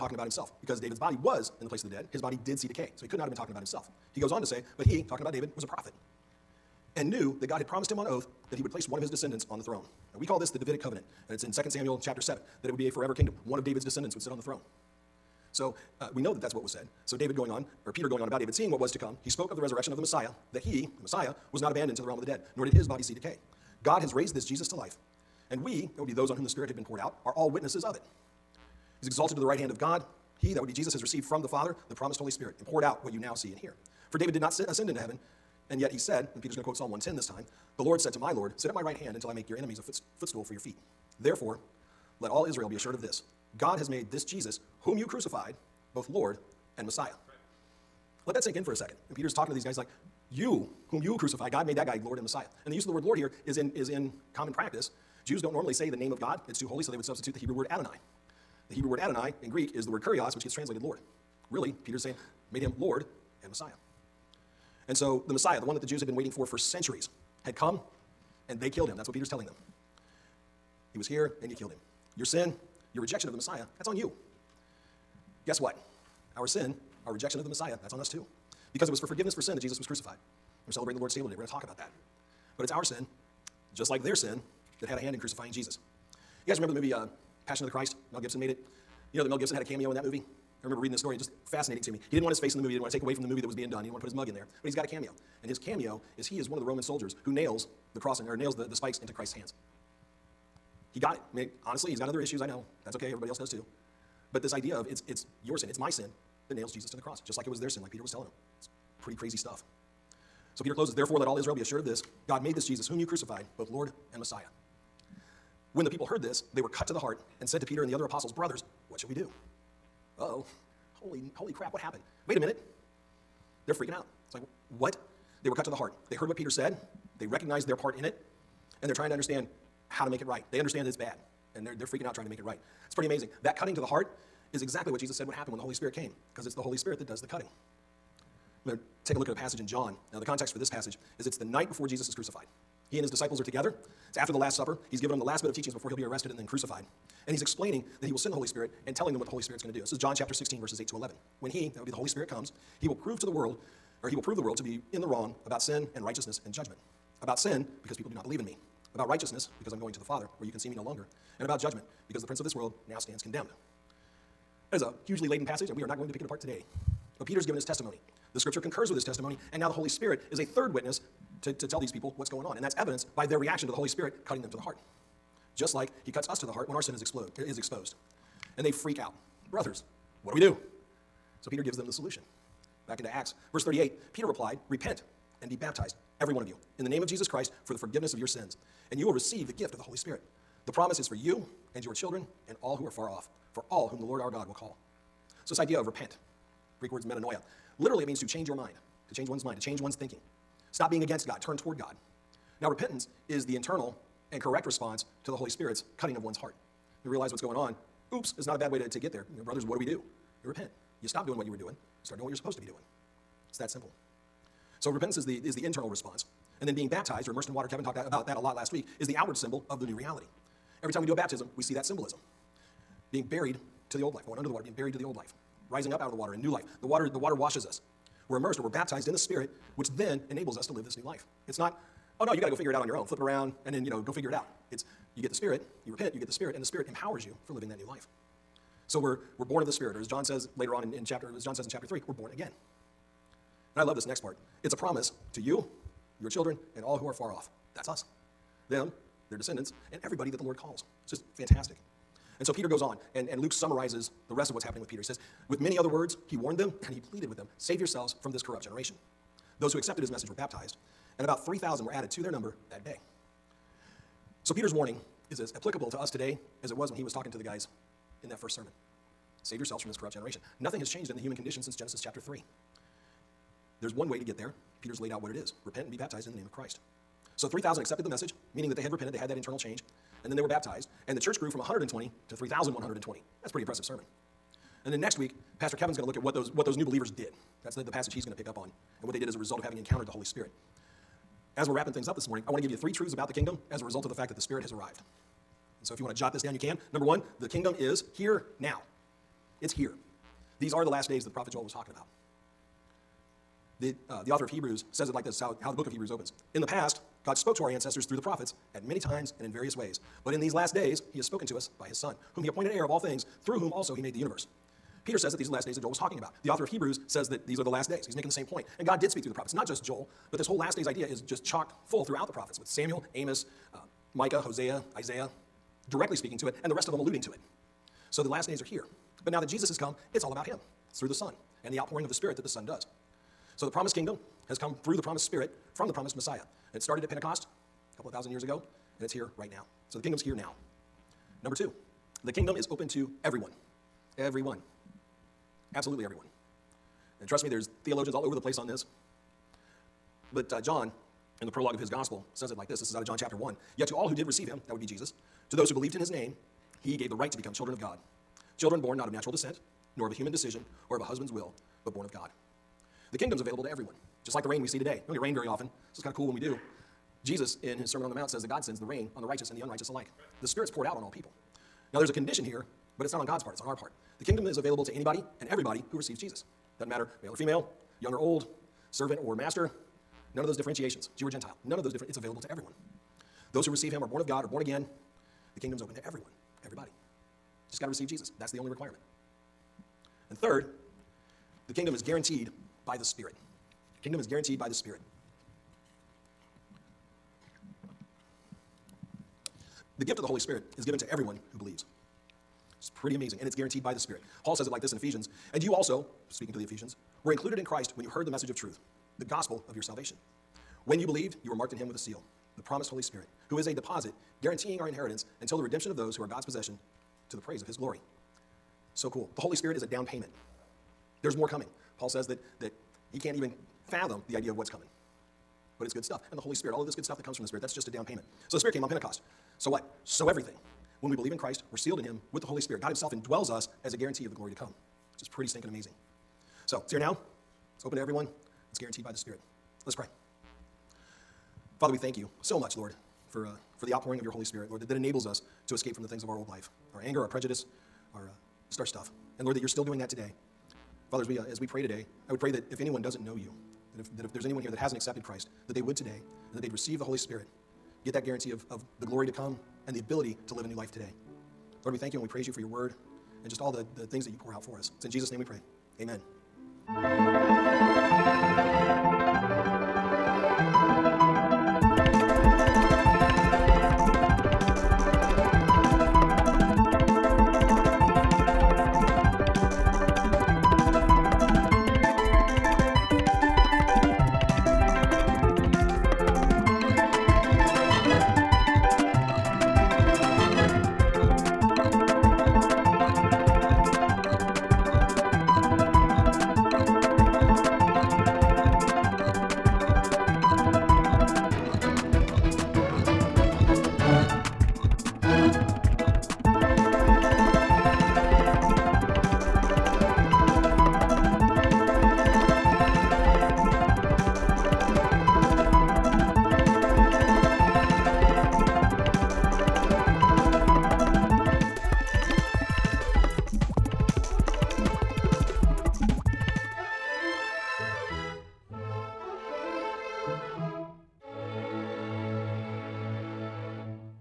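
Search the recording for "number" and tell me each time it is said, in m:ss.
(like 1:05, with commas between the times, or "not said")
4:22, 4:56, 5:41.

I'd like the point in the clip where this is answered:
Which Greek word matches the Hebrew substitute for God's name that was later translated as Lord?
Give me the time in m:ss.
1:00.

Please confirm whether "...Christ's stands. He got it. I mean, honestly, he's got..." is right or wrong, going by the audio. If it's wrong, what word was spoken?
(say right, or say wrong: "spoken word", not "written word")
wrong: "hands", not "stands".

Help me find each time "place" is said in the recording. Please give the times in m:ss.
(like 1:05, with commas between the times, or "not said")
0:01, 0:08, 5:48.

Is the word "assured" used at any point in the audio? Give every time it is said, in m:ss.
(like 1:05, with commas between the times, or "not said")
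0:42, 1:51.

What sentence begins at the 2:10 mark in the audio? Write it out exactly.
They understand that it's bad, and they're, they're freaking out trying to make it right.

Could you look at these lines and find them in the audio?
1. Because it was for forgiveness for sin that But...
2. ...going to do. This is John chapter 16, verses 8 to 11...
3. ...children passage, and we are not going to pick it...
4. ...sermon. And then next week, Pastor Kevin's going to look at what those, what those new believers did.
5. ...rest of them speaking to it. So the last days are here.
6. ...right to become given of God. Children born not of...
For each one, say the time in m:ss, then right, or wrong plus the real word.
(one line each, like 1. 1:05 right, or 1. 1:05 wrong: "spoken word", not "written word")
1. 1:18 wrong: "Jesus", not "But"
2. 2:29 right
3. 2:45 wrong: "laden", not "children"
4. 4:43 right
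5. 5:26 wrong: "alluding", not "speaking"
6. 5:57 wrong: "children", not "given".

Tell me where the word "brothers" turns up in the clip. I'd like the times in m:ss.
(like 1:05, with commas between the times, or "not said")
1:58, 2:59, 3:29.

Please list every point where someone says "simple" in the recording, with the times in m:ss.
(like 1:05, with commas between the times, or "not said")
3:33.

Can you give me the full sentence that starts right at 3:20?
Stop being against God, turn toward God.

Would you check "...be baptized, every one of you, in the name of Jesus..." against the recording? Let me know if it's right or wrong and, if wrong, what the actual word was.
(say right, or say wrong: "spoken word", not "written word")
right.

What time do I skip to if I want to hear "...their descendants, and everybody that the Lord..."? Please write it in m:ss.
4:09.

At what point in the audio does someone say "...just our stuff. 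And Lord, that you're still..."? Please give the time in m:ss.
7:28.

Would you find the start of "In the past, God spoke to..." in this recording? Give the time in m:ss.
5:06.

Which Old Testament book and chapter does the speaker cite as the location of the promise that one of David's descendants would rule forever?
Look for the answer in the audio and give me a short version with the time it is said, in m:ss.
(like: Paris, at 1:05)
2 Samuel chapter 7, at 0:11.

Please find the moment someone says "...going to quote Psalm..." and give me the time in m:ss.
0:36.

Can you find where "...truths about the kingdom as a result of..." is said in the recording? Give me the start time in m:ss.
4:52.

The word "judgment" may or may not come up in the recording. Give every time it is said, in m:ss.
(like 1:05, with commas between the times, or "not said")
2:36, 2:41.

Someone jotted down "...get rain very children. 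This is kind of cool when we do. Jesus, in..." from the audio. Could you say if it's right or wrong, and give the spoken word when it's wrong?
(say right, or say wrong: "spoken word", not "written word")
wrong: "often", not "children".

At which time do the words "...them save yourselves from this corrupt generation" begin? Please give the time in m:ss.
4:17.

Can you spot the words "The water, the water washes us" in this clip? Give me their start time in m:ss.
3:46.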